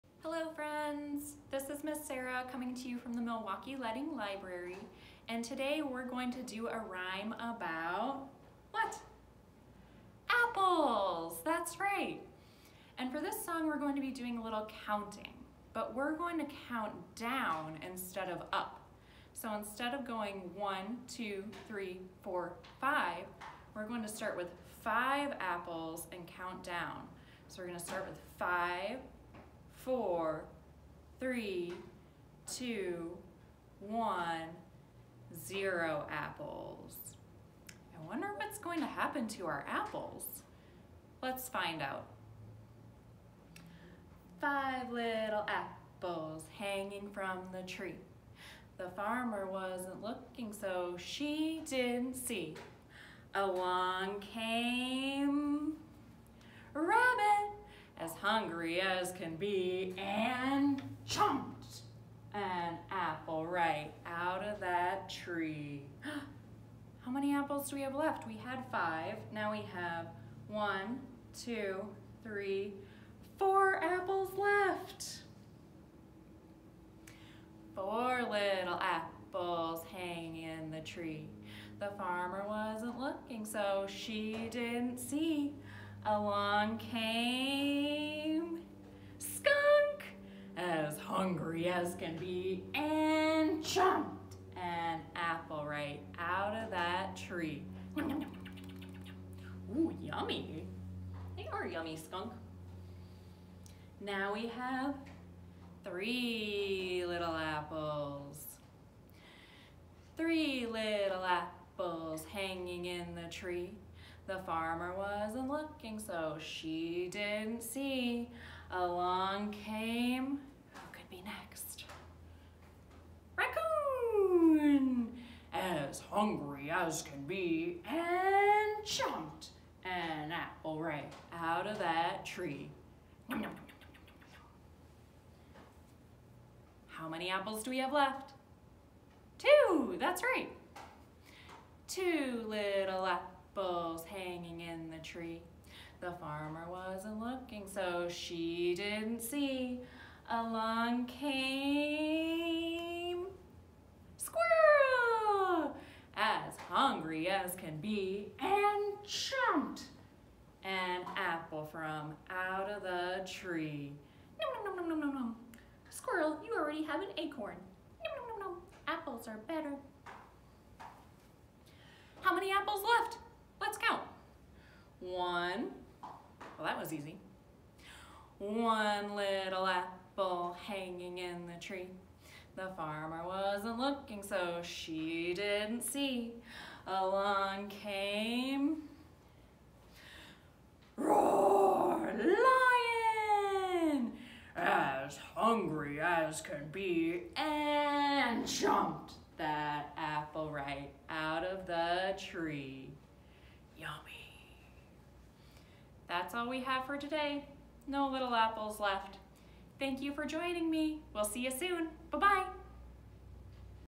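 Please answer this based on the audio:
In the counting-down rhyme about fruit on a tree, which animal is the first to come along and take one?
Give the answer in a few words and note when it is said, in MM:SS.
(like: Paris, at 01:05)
Rabbit, at 00:56.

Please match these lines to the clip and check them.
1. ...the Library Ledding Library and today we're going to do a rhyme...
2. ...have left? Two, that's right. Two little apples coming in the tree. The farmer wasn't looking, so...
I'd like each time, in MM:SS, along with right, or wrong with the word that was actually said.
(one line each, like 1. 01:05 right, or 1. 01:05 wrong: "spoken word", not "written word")
1. 00:03 wrong: "Milwaukie", not "Library"
2. 02:17 wrong: "hanging", not "coming".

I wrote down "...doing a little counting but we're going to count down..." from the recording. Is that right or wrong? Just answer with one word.
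right.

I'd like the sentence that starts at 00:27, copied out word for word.
So we're gonna start with five, four, three, two, one, zero apples.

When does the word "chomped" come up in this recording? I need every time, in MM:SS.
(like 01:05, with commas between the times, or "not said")
01:33, 02:08.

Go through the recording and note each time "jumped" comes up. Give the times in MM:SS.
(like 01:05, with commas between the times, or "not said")
02:39, 03:18.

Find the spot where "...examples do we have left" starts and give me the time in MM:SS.
01:07.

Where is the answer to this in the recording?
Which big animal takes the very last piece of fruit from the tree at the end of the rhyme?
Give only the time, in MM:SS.
03:13.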